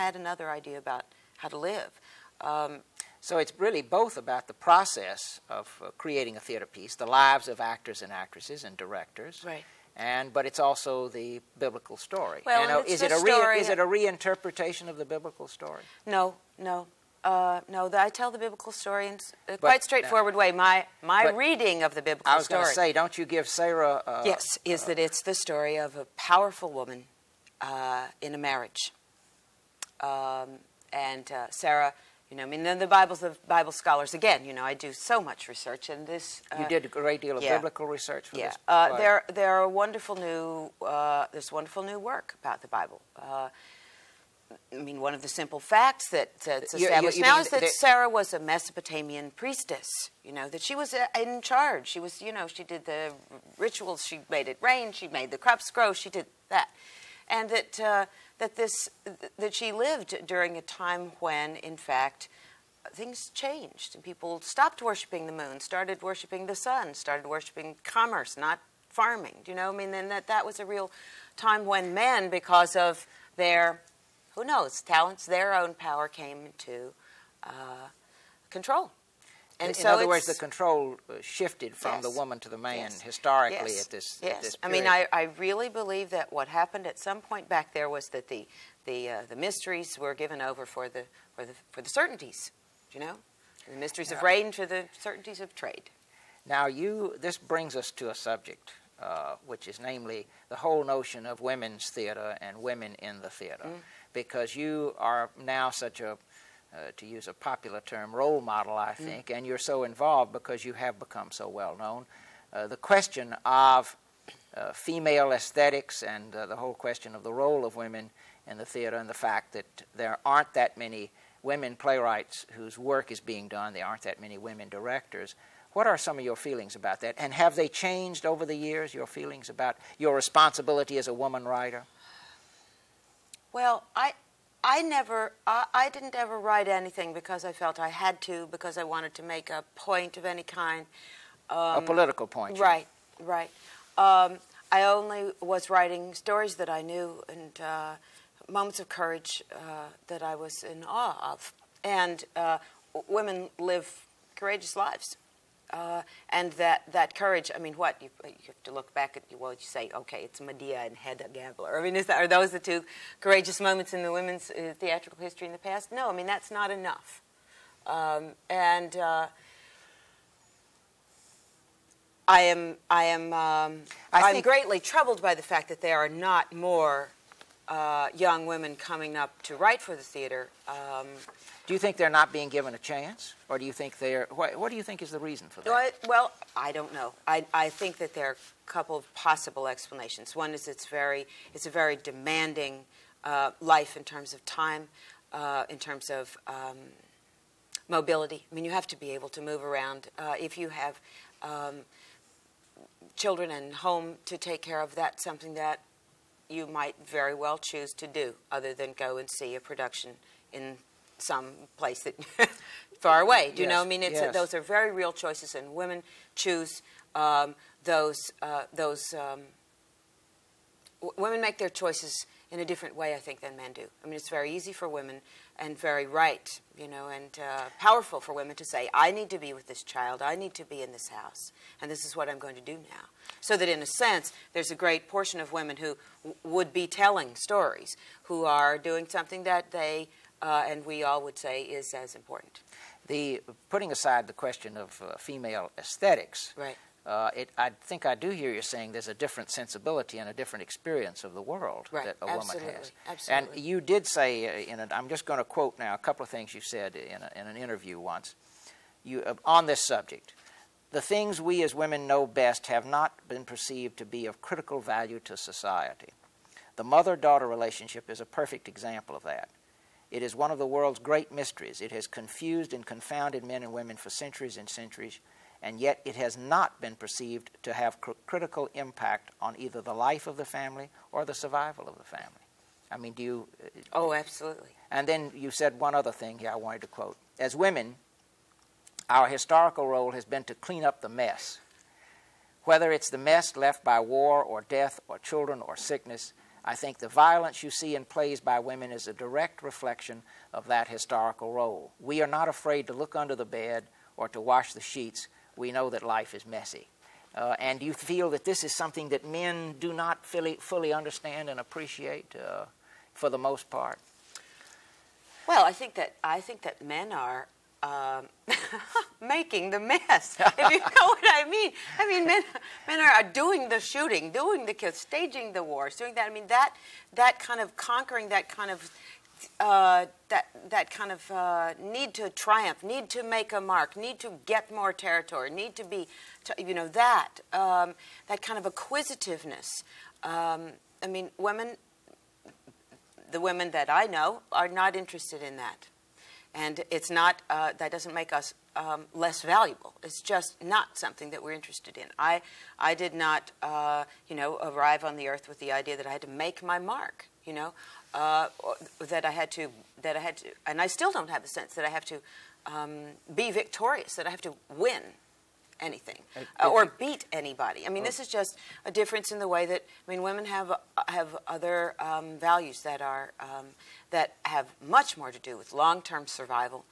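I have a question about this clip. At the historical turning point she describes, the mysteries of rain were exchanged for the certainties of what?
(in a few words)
trade.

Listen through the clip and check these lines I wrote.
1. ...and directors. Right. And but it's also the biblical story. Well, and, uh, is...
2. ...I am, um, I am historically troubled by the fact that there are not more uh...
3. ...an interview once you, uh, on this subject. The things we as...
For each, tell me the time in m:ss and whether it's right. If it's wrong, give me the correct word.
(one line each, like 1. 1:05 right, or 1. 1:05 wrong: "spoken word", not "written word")
1. 0:08 right
2. 2:52 wrong: "greatly", not "historically"
3. 4:17 right.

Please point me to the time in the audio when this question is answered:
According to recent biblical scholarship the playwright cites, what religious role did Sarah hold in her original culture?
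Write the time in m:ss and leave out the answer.
0:48.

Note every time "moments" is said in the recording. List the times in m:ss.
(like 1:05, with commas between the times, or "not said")
2:28, 2:43.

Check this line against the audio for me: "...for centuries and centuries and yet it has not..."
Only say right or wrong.
right.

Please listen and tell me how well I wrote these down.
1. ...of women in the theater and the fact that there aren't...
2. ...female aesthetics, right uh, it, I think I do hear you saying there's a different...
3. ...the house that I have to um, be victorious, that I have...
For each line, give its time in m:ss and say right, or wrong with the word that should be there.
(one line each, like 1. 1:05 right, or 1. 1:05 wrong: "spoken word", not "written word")
1. 1:57 right
2. 4:05 right
3. 6:01 wrong: "sense", not "house".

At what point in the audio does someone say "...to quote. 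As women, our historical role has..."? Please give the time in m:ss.
4:46.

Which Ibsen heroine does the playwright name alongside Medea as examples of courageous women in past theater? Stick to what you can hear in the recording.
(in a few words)
Hedda Gabler.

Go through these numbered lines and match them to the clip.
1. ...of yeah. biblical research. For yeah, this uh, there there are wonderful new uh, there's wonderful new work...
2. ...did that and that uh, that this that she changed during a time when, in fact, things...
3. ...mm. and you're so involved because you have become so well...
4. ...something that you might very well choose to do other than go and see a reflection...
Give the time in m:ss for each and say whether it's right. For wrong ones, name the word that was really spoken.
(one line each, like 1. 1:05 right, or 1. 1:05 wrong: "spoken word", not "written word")
1. 0:37 right
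2. 0:56 wrong: "lived", not "changed"
3. 1:49 right
4. 3:25 wrong: "production", not "reflection".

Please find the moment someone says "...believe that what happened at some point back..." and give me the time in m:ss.
1:25.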